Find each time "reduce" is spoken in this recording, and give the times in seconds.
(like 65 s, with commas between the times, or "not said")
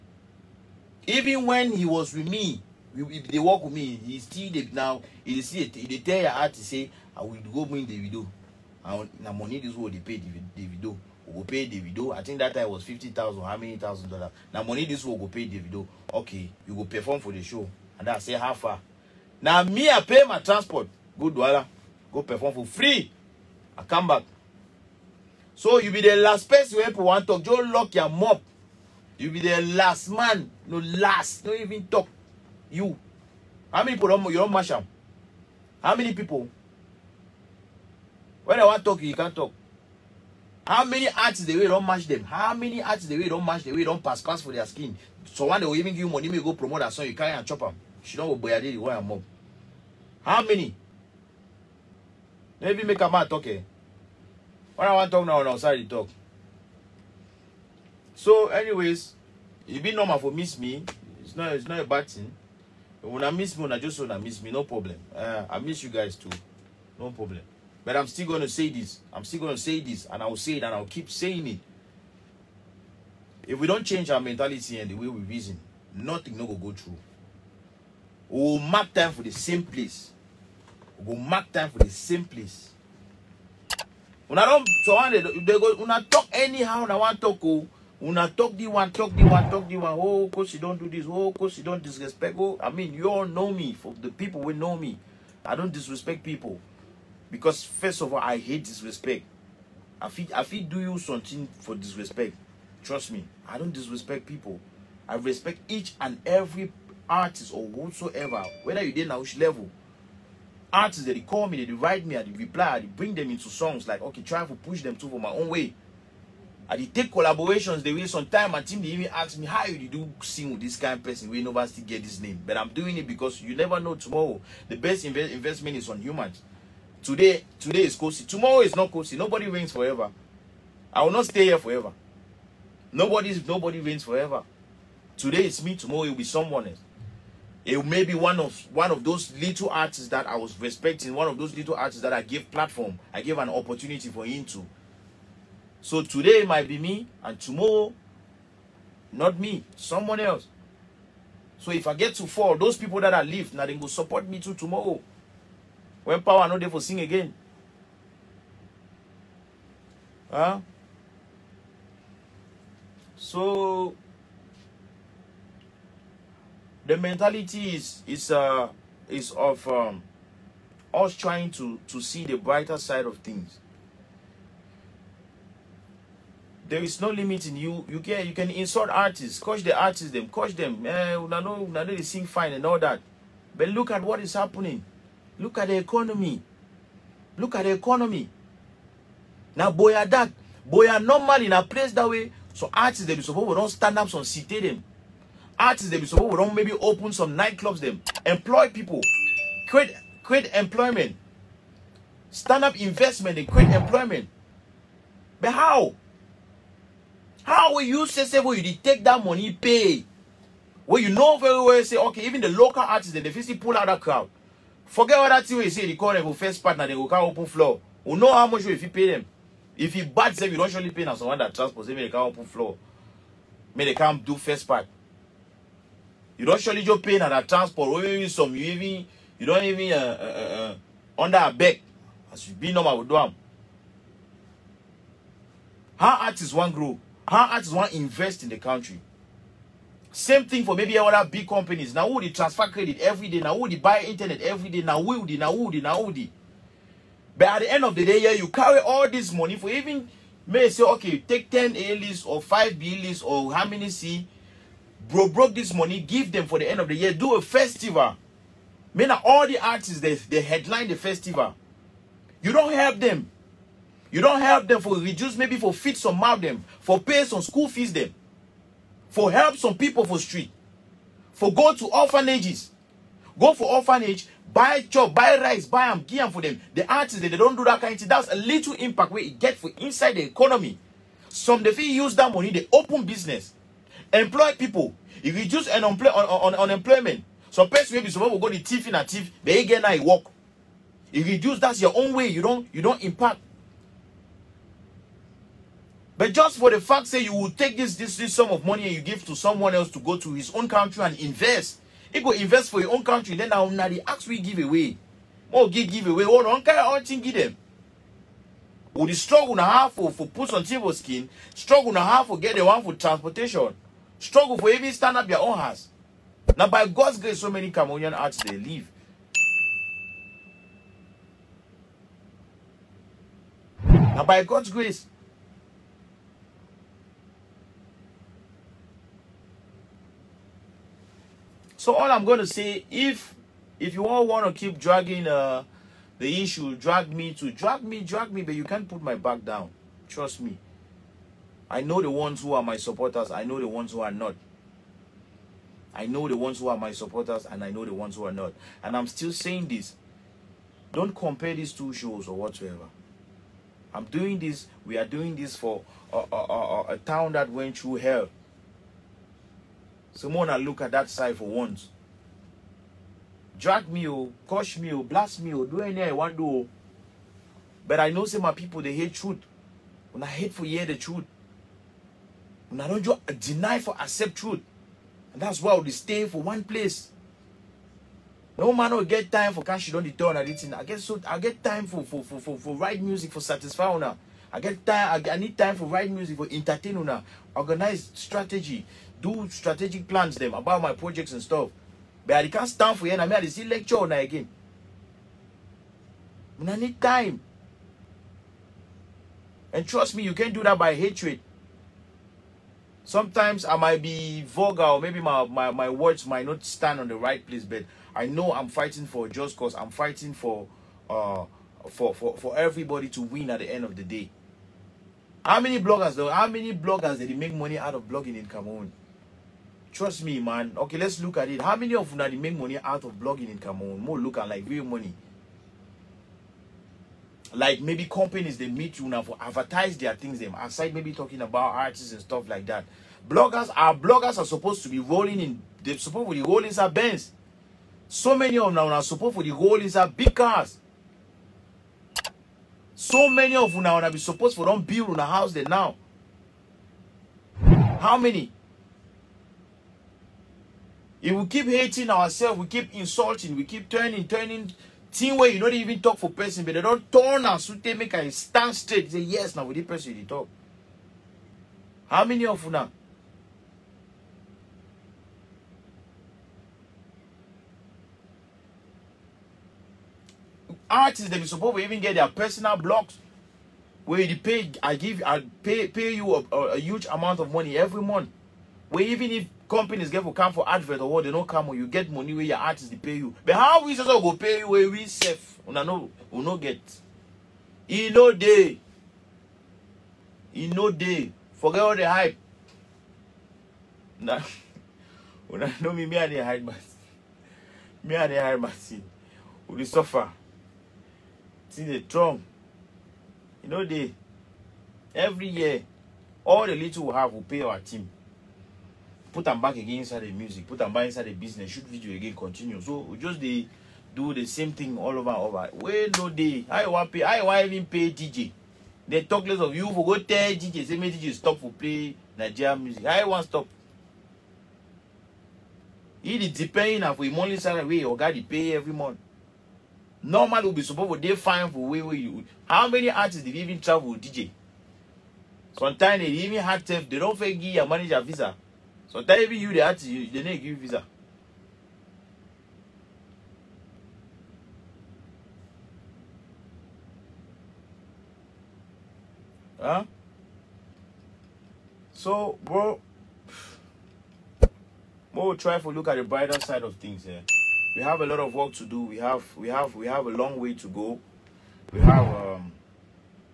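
264 s, 285 s, 291 s.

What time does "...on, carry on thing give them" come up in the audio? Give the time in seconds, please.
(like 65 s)
306 s.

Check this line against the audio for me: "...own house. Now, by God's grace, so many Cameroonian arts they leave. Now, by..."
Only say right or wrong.
right.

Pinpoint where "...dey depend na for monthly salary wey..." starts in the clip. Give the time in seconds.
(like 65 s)
526 s.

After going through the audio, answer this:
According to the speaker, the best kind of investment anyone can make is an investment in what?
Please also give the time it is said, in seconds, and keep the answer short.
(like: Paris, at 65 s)
humans, at 126 s.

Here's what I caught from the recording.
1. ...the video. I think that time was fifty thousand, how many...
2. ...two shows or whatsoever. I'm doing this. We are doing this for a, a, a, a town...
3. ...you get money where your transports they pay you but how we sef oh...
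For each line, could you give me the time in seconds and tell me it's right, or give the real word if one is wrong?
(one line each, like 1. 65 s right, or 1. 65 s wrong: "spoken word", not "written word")
1. 11 s right
2. 351 s right
3. 481 s wrong: "artists", not "transports".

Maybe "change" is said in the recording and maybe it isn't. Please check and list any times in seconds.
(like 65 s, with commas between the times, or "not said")
73 s.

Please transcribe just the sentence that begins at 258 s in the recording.
Mean all the artists, they, they headline the festival.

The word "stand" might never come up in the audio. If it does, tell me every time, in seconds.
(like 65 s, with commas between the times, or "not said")
193 s, 202 s, 314 s, 392 s, 406 s, 458 s.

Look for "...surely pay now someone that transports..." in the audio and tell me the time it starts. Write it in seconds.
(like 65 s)
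220 s.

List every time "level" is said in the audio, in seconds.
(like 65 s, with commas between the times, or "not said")
109 s.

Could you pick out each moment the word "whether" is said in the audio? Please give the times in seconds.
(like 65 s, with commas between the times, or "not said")
108 s.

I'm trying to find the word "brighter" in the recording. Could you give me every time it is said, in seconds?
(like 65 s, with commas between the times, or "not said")
172 s, 556 s.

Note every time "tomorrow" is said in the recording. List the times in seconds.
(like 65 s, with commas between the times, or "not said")
123 s, 128 s, 135 s, 147 s, 154 s.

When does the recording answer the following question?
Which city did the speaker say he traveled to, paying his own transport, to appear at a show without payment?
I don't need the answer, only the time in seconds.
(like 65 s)
21 s.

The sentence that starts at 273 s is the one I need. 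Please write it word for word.
Go for orphanage, buy chop, buy rice, buy am, give them for them.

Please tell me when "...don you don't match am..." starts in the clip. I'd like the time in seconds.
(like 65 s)
34 s.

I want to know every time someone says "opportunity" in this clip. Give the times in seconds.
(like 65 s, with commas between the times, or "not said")
143 s.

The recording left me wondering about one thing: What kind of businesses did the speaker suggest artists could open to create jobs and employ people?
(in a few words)
nightclubs.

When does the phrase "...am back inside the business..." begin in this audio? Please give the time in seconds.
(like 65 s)
510 s.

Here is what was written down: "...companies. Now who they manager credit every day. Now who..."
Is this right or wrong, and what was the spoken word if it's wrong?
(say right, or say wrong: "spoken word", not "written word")
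wrong: "transfer", not "manager".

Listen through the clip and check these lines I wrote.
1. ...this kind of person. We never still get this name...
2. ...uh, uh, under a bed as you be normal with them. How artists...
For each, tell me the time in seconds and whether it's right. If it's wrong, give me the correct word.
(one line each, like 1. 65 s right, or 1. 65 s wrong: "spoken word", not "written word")
1. 120 s right
2. 230 s right.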